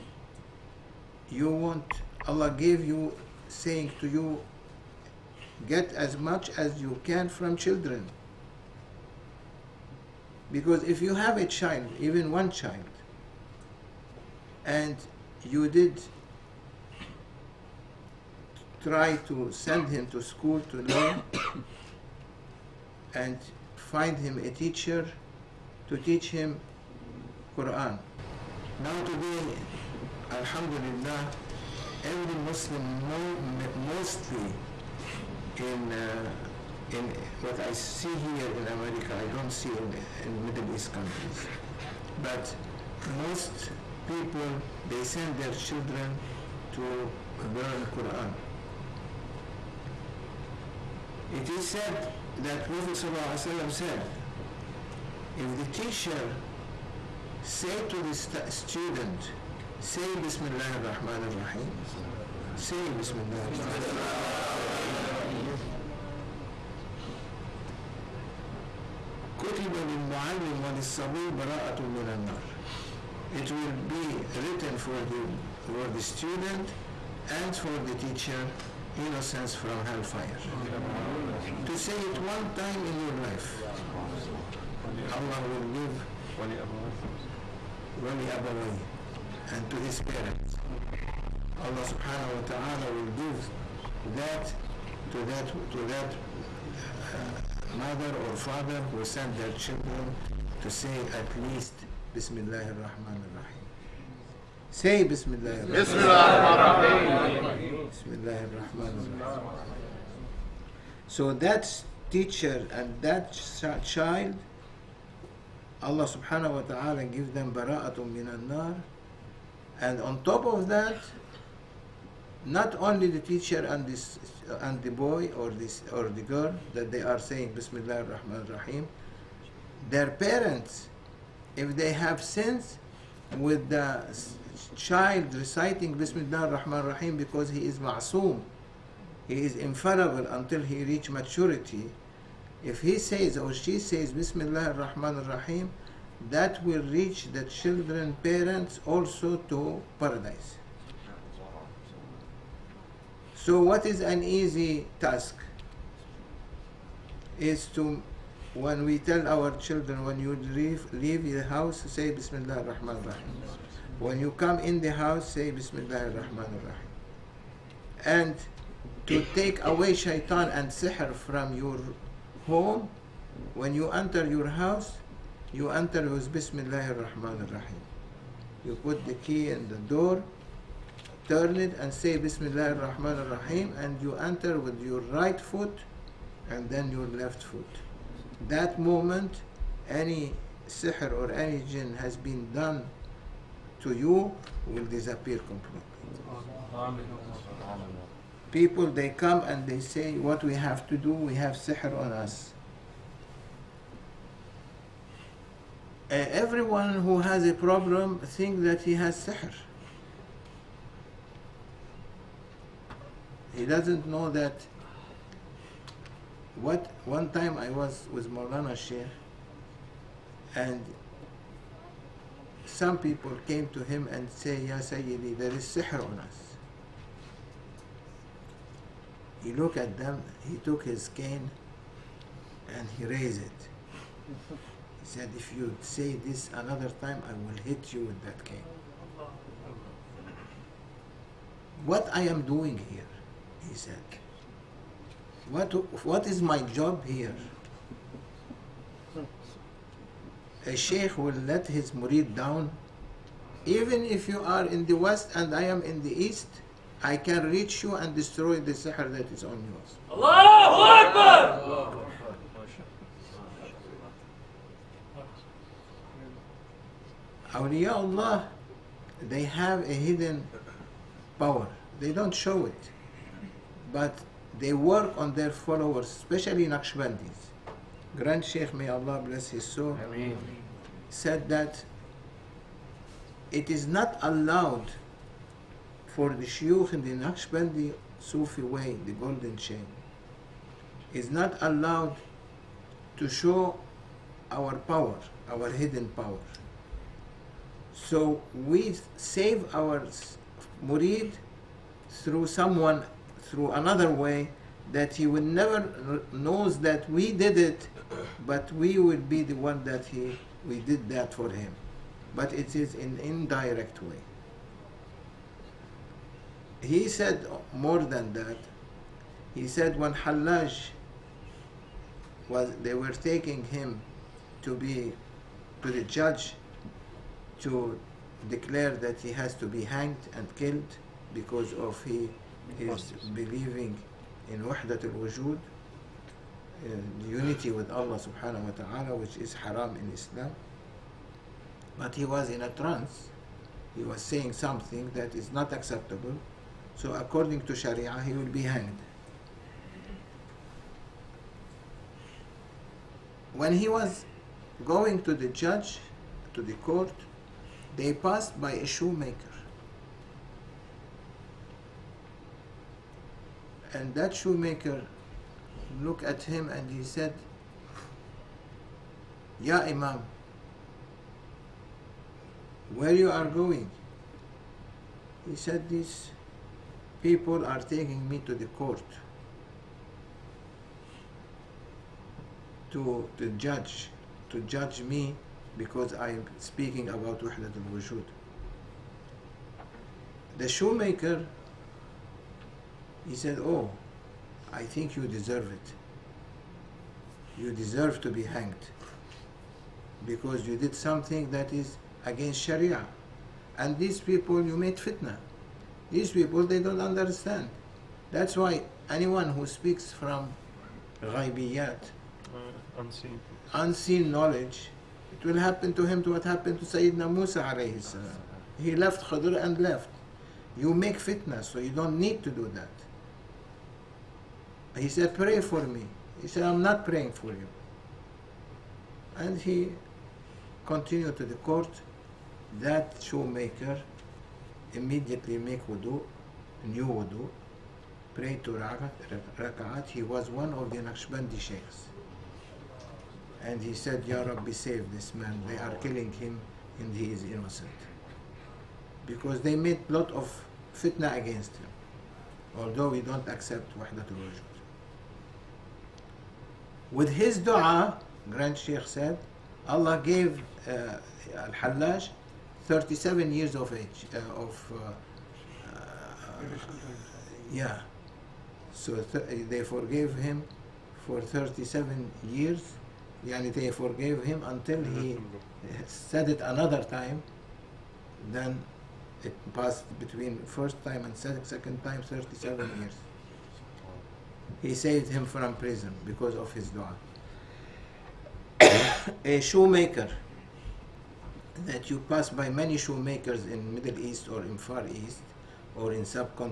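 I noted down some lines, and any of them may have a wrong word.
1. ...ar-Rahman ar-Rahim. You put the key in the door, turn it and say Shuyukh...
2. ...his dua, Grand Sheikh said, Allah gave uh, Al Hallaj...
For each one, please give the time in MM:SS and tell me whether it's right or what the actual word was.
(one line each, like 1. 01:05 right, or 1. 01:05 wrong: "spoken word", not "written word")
1. 02:56 wrong: "Bismillah", not "Shuyukh"
2. 07:37 right.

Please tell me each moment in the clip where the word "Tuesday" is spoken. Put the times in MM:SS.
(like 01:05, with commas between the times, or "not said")
not said.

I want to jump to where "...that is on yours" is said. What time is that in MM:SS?
04:19.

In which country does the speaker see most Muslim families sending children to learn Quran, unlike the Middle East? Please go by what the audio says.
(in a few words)
America.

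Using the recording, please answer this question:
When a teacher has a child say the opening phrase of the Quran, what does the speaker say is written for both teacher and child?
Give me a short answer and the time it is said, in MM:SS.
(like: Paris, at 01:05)
innocence from hellfire, at 01:18.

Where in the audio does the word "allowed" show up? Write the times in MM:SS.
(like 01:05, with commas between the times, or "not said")
04:44, 04:51.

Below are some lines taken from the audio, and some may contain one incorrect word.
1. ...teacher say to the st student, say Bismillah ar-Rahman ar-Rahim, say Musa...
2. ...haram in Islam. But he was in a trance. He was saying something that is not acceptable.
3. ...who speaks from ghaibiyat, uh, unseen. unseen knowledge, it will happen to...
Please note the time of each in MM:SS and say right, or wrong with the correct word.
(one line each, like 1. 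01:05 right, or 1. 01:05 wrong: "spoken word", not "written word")
1. 00:55 wrong: "Bismillah", not "Musa"
2. 05:39 right
3. 06:49 right.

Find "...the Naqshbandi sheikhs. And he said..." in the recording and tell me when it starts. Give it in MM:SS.
07:20.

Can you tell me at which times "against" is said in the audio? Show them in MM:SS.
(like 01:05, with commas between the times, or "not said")
06:42, 07:31.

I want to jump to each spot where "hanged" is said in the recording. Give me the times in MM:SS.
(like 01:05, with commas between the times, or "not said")
05:29, 05:48, 06:38.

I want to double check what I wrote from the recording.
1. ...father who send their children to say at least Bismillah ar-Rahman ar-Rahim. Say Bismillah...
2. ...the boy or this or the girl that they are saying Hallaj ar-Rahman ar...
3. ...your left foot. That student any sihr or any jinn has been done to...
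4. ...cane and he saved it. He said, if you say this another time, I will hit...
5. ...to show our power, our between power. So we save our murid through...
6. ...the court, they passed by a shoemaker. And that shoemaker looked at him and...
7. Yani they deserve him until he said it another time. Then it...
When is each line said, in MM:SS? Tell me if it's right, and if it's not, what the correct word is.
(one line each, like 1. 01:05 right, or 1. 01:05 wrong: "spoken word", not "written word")
1. 01:38 right
2. 02:04 wrong: "Bismillah", not "Hallaj"
3. 03:06 wrong: "moment", not "student"
4. 03:51 wrong: "raised", not "saved"
5. 04:53 wrong: "hidden", not "between"
6. 05:56 right
7. 07:53 wrong: "forgave", not "deserve".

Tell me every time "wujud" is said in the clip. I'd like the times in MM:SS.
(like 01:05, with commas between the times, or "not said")
05:35, 06:27, 07:34.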